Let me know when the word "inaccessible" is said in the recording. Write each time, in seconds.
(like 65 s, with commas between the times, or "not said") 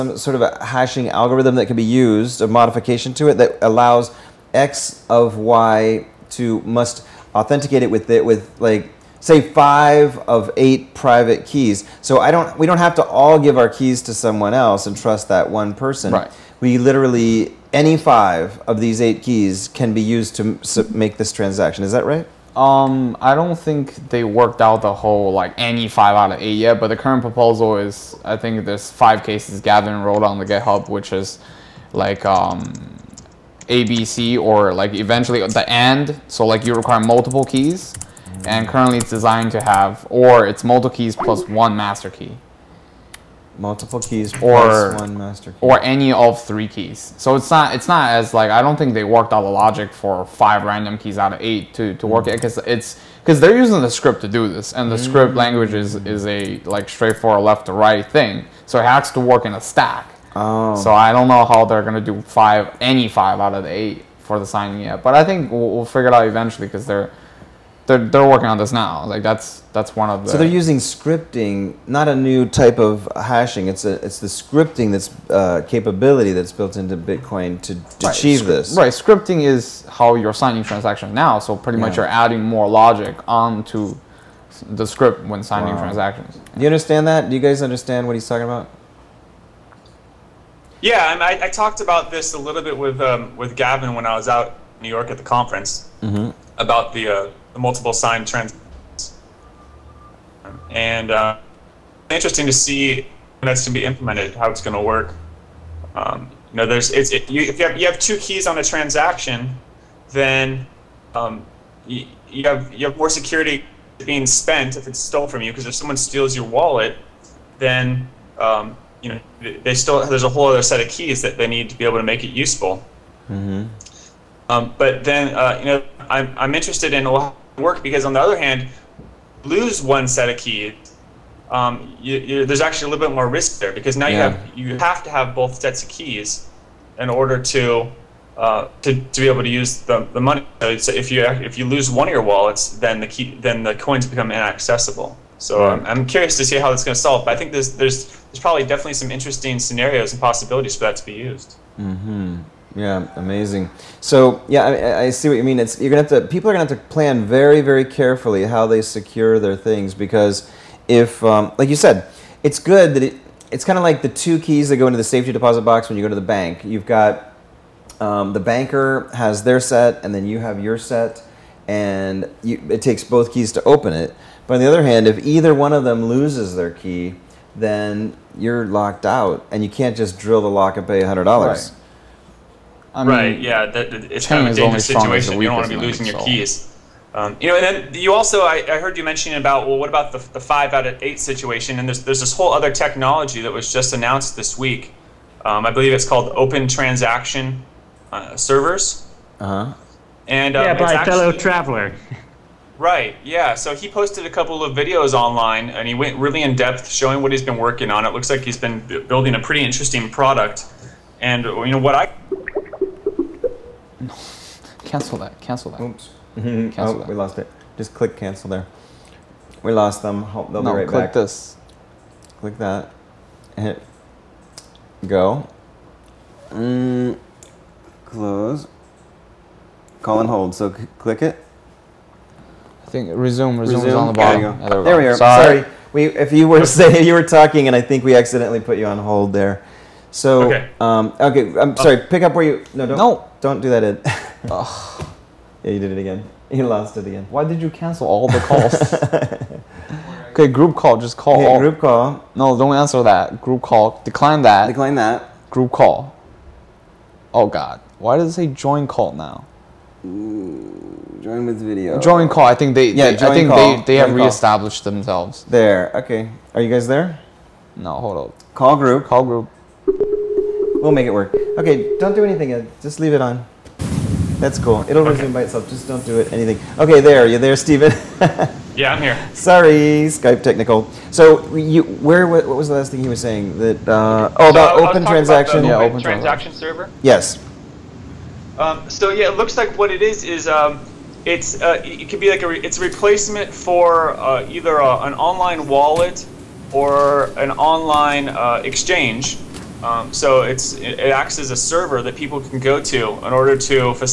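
144 s.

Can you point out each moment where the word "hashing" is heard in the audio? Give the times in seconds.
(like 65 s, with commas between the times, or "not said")
0 s, 73 s.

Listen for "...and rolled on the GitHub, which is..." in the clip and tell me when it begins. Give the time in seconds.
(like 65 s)
29 s.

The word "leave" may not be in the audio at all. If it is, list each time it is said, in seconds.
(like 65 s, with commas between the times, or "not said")
273 s.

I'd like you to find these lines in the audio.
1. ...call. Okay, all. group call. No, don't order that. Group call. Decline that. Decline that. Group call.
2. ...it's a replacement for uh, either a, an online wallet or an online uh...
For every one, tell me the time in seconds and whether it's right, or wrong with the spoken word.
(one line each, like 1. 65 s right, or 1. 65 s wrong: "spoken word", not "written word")
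1. 251 s wrong: "answer", not "order"
2. 292 s right.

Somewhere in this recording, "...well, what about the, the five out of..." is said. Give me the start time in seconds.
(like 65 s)
189 s.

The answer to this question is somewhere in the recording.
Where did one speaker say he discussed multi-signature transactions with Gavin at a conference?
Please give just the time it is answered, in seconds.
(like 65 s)
94 s.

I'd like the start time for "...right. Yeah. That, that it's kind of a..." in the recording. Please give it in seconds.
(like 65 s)
183 s.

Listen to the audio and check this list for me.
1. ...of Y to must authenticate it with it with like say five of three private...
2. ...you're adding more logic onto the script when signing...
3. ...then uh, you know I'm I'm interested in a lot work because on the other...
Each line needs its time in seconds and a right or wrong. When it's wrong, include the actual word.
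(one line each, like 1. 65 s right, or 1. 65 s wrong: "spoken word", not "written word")
1. 5 s wrong: "eight", not "three"
2. 81 s right
3. 125 s right.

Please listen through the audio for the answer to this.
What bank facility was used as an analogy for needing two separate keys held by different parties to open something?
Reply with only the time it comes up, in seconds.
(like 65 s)
165 s.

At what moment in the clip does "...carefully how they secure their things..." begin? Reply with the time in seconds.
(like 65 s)
157 s.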